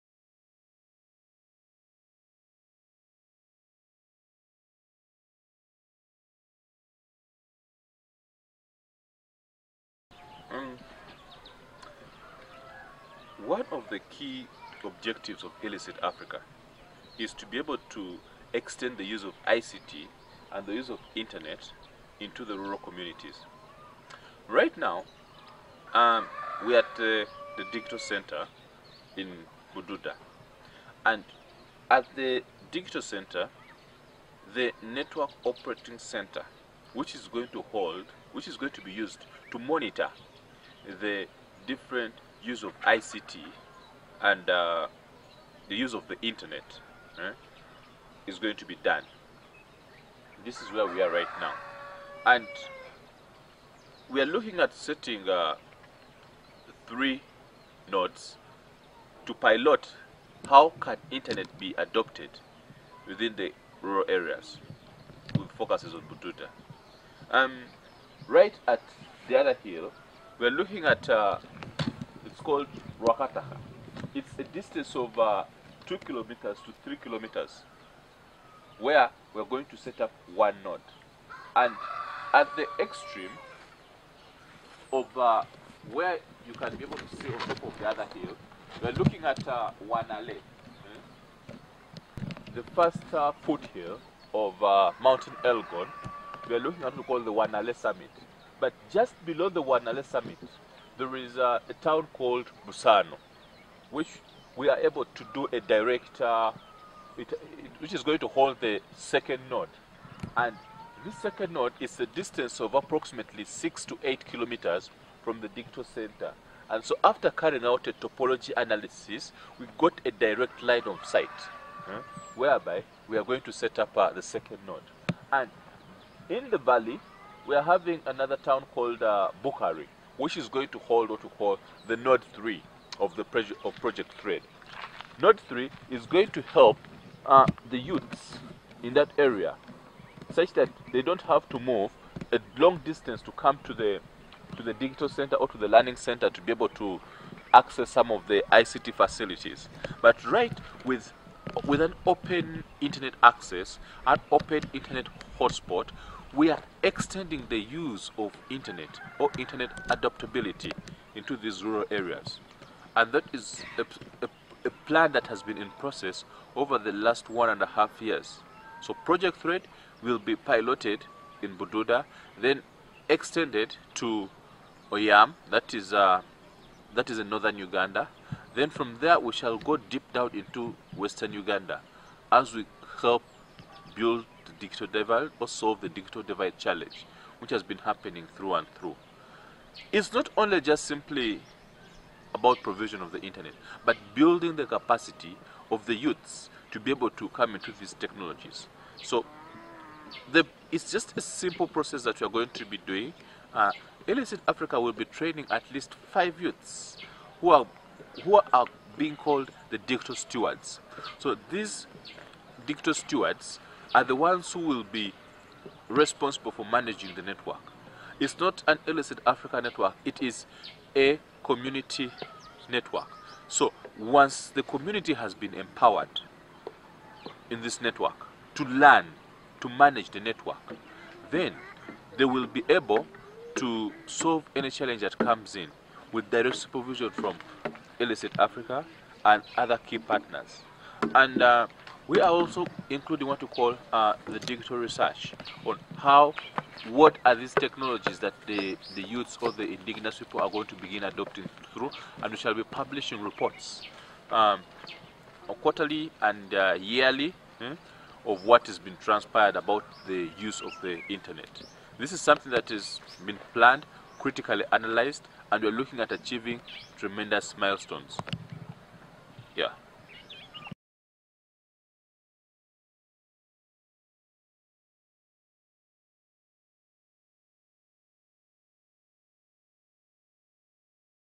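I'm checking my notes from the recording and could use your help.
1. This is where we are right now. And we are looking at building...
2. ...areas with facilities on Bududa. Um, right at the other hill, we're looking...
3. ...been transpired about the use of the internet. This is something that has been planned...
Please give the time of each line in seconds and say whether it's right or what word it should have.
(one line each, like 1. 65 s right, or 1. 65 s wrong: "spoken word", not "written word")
1. 50 s wrong: "setting", not "building"
2. 64 s wrong: "focuses", not "facilities"
3. 258 s right.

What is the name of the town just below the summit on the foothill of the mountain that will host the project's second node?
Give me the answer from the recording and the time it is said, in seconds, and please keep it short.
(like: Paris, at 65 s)
Busano, at 102 s.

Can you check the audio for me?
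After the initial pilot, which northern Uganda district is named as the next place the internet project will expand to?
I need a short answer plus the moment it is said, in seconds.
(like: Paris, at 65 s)
Oyam, at 174 s.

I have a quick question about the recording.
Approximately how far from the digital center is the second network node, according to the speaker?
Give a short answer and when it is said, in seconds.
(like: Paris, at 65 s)
6 to 8 kilometers, at 113 s.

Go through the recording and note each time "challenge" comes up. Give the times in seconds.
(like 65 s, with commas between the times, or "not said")
186 s, 234 s.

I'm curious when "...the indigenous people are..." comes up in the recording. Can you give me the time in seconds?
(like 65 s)
249 s.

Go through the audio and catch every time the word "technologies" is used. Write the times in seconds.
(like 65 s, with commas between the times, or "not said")
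197 s, 247 s.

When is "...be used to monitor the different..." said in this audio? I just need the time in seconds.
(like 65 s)
38 s.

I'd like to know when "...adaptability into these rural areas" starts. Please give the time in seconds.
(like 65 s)
159 s.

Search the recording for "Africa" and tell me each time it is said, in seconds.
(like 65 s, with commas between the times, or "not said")
16 s, 204 s, 219 s, 238 s.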